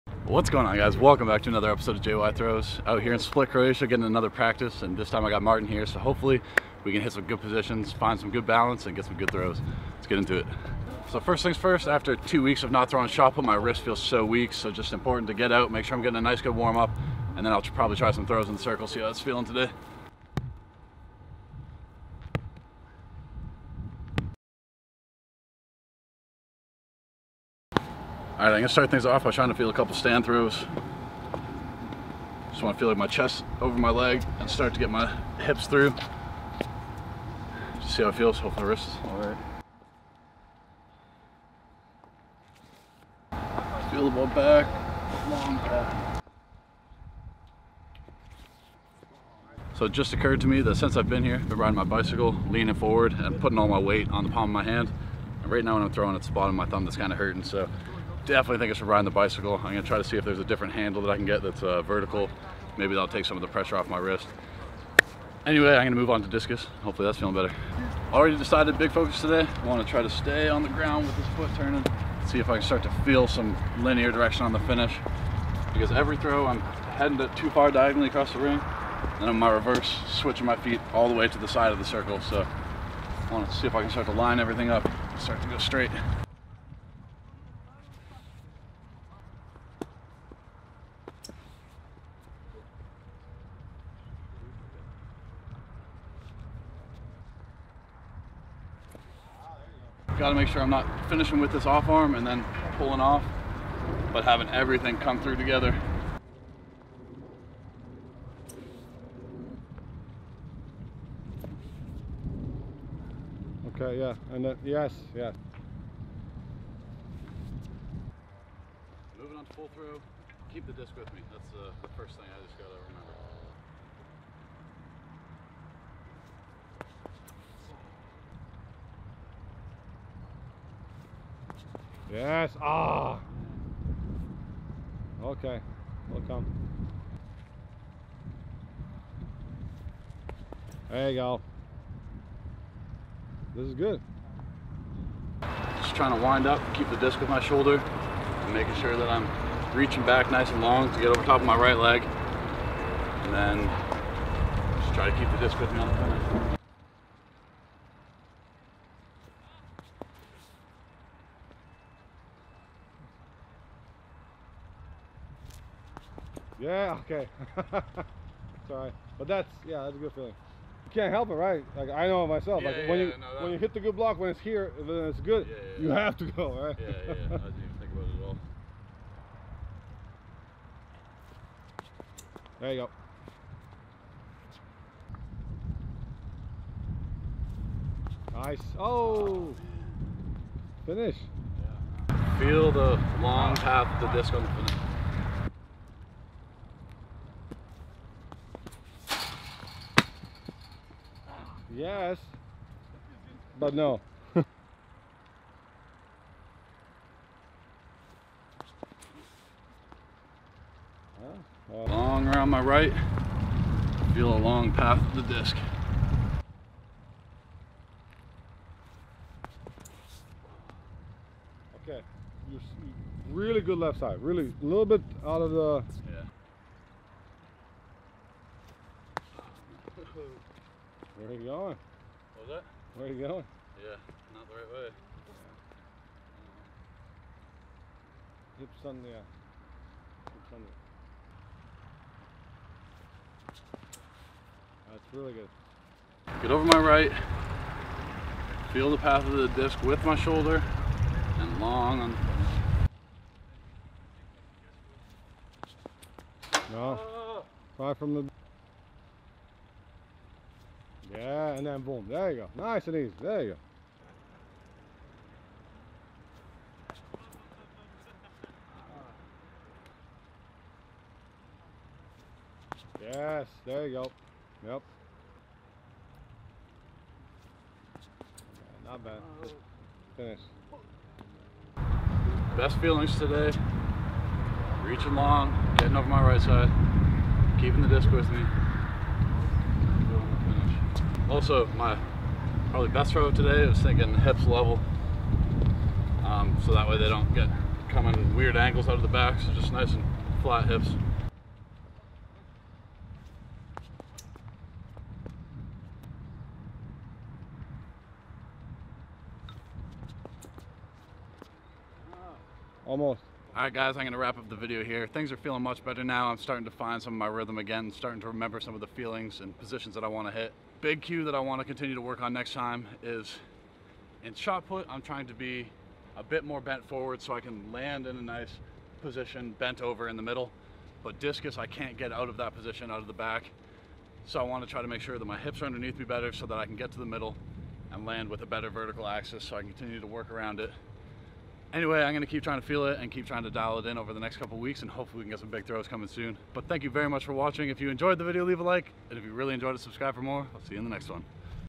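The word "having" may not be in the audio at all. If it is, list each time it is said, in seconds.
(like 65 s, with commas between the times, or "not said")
104 s.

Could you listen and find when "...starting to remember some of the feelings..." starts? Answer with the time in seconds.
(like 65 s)
317 s.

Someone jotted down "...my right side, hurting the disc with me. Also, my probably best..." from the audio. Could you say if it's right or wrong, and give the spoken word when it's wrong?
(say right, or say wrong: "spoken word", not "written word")
wrong: "keeping", not "hurting".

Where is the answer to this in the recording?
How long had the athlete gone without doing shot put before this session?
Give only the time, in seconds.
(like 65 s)
12 s.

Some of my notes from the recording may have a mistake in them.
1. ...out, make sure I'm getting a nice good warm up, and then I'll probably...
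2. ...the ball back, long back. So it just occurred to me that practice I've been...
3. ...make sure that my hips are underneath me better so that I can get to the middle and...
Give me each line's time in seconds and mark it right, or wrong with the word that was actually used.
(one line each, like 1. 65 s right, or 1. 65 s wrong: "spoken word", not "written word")
1. 15 s right
2. 44 s wrong: "since", not "practice"
3. 334 s right.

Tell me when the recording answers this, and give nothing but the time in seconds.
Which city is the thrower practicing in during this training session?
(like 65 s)
3 s.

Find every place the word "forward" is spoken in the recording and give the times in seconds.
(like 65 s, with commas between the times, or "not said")
52 s, 326 s.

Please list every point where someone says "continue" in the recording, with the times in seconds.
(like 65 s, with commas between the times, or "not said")
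321 s, 339 s.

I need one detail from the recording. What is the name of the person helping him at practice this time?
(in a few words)
Martin.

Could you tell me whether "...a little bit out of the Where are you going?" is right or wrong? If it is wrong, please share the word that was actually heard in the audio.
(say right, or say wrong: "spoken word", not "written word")
right.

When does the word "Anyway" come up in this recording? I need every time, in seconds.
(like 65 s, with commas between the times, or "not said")
65 s, 341 s.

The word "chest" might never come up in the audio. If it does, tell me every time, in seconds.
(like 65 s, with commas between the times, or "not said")
33 s.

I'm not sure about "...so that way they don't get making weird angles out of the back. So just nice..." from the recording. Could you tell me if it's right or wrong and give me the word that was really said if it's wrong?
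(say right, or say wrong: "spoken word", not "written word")
wrong: "coming", not "making".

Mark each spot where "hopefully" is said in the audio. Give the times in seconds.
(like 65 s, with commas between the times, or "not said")
5 s, 38 s, 66 s, 344 s.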